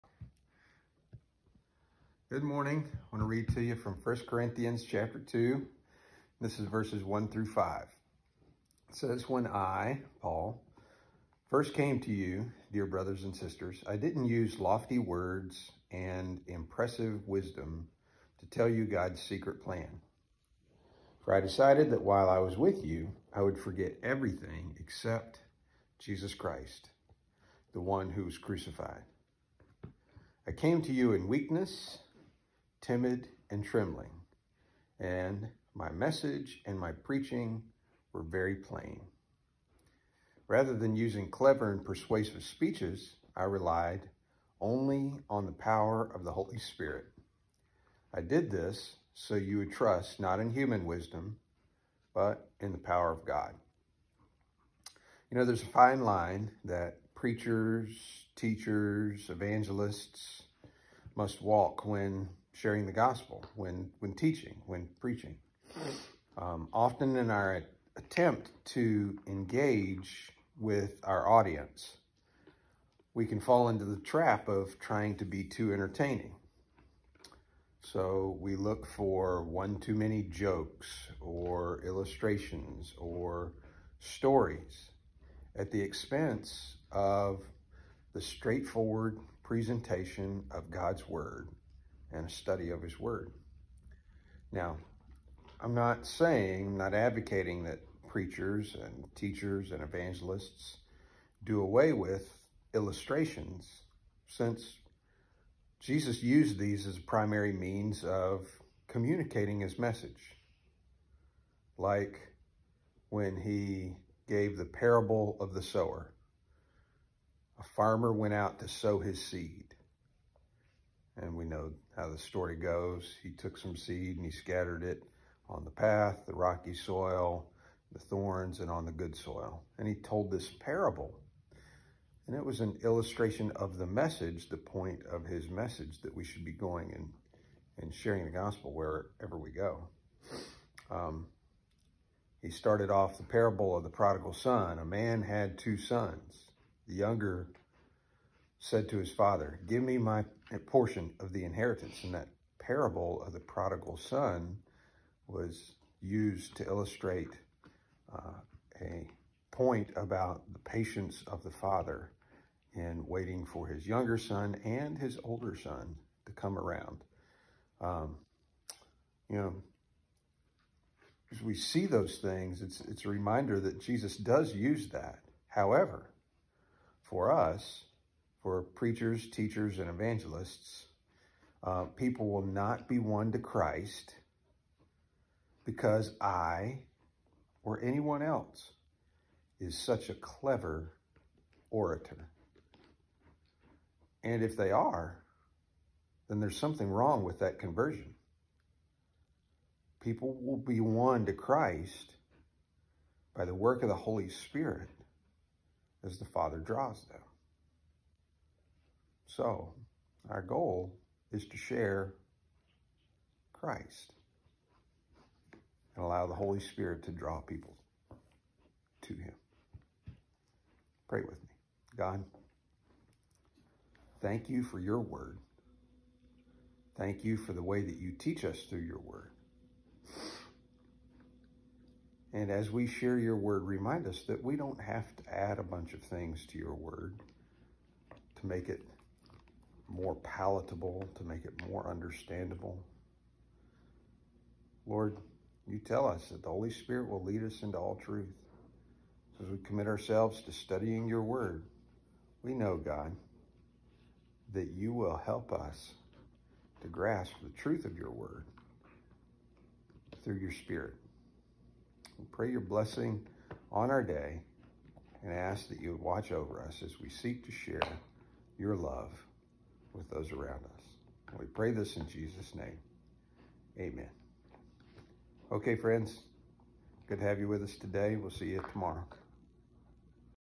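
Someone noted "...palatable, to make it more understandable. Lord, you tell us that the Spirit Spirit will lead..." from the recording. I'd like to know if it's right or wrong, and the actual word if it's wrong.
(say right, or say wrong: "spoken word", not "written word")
wrong: "Holy", not "Spirit".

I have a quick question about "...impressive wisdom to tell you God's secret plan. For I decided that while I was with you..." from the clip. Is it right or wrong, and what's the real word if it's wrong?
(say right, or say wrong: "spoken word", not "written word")
right.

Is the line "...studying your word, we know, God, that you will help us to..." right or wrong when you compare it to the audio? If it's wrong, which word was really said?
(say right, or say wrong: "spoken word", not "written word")
right.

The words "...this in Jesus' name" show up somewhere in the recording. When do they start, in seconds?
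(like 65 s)
271 s.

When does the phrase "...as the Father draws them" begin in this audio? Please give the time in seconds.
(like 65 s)
206 s.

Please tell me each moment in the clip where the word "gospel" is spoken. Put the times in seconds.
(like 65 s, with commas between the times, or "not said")
62 s, 138 s.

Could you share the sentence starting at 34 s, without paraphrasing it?
And my message and my preaching were very plain.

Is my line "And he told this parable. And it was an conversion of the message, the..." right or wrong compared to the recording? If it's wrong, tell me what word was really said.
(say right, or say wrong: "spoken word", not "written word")
wrong: "illustration", not "conversion".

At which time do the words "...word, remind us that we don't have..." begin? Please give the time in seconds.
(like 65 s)
233 s.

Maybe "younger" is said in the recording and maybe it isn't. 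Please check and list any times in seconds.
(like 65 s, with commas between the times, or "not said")
146 s, 163 s.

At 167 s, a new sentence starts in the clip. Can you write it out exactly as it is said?
Um, you know, as we see those things, it's, it's a reminder that Jesus does use that.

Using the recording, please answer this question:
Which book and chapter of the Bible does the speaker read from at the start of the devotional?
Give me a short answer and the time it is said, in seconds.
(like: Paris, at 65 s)
1 Corinthians 2, at 4 s.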